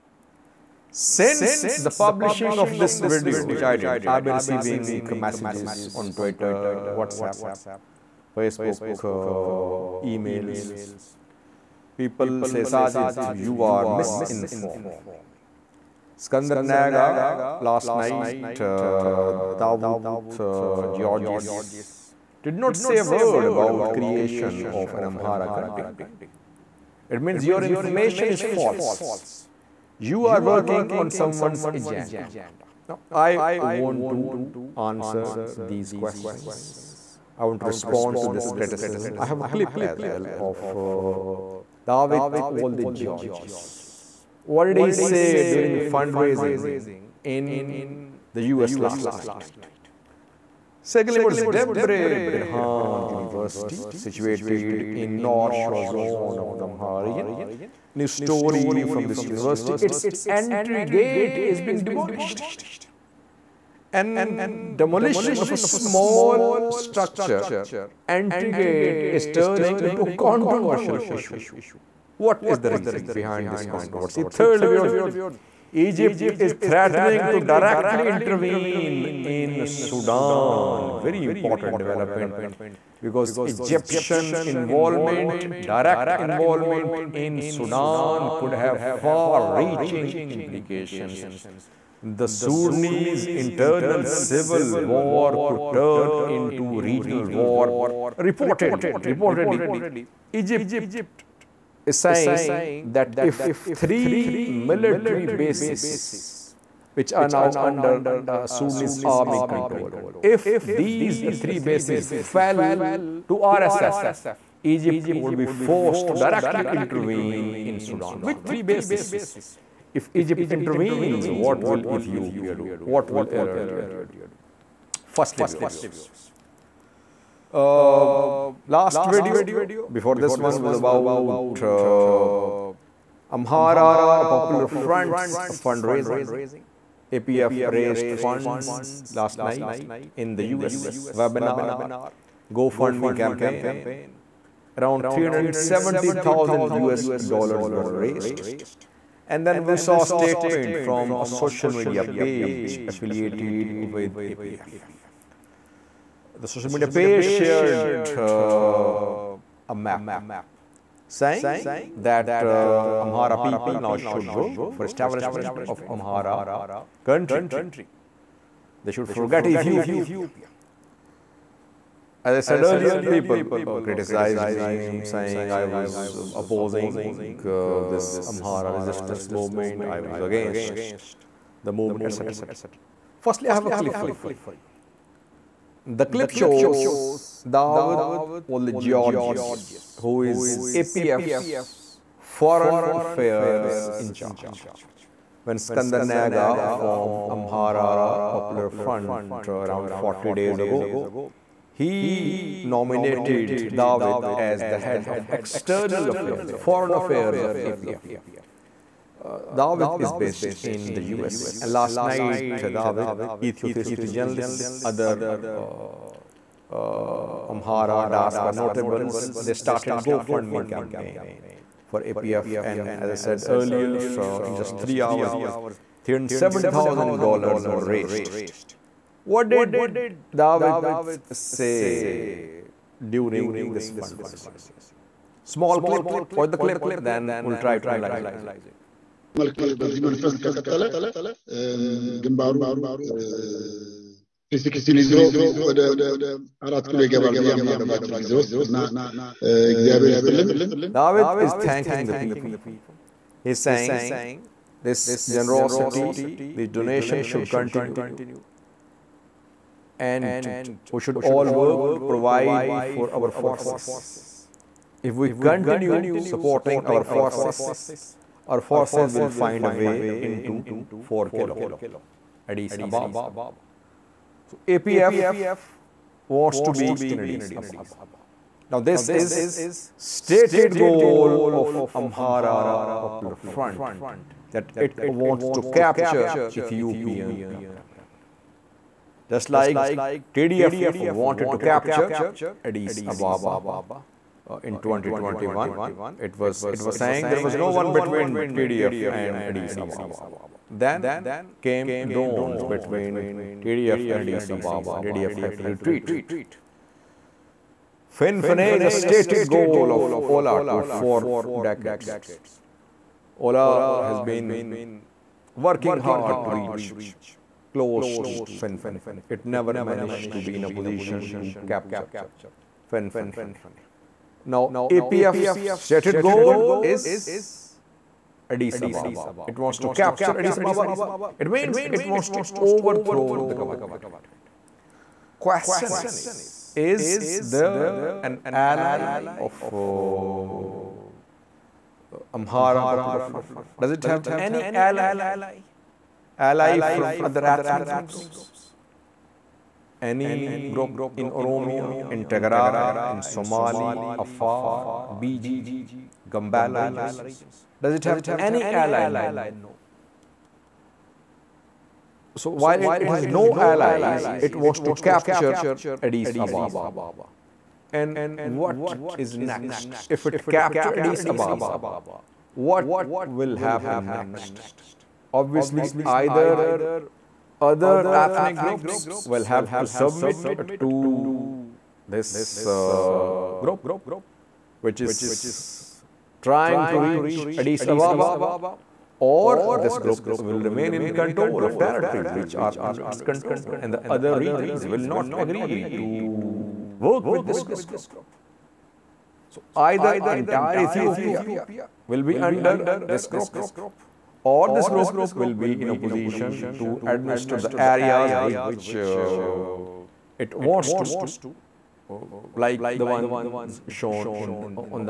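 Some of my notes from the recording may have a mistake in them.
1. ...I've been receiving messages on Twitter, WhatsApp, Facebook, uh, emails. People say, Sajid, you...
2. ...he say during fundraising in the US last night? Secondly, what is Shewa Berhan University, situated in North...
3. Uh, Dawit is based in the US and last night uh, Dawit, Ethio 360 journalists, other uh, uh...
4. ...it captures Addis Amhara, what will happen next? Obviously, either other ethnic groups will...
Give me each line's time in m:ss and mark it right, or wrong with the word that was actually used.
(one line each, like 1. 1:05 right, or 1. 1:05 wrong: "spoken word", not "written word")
1. 0:04 right
2. 0:44 wrong: "Debre", not "Shewa"
3. 3:29 right
4. 6:10 wrong: "Ababa", not "Amhara".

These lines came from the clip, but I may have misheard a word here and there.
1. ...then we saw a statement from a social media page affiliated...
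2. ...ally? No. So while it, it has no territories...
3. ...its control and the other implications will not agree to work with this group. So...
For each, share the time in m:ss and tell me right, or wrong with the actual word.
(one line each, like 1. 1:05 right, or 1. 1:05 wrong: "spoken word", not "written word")
1. 2:29 right
2. 5:58 wrong: "allies", not "territories"
3. 6:33 wrong: "regions", not "implications".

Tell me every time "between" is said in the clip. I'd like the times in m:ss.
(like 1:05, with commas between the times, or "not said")
4:57, 5:02.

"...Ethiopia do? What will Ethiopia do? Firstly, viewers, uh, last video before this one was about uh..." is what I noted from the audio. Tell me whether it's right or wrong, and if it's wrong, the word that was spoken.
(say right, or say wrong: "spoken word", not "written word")
wrong: "Eritrea", not "Ethiopia".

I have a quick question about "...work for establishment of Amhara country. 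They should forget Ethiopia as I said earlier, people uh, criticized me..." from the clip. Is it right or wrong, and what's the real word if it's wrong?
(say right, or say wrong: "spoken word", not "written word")
right.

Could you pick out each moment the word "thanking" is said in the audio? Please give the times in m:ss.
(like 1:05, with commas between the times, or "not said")
4:11.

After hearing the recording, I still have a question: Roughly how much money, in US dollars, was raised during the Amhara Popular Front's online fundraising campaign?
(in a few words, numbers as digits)
$370,000.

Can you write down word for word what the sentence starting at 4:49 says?
Just like TDF wanted to capture Addis Ababa uh, in 2021.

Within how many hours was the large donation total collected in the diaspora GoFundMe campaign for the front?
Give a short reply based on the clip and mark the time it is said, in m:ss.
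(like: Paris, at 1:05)
3 hours, at 3:44.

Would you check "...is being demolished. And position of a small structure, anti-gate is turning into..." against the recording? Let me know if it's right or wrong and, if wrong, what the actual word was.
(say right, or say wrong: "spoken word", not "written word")
wrong: "demolition", not "position".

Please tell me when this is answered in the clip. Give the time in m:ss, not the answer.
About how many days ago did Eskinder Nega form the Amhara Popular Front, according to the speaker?
3:19.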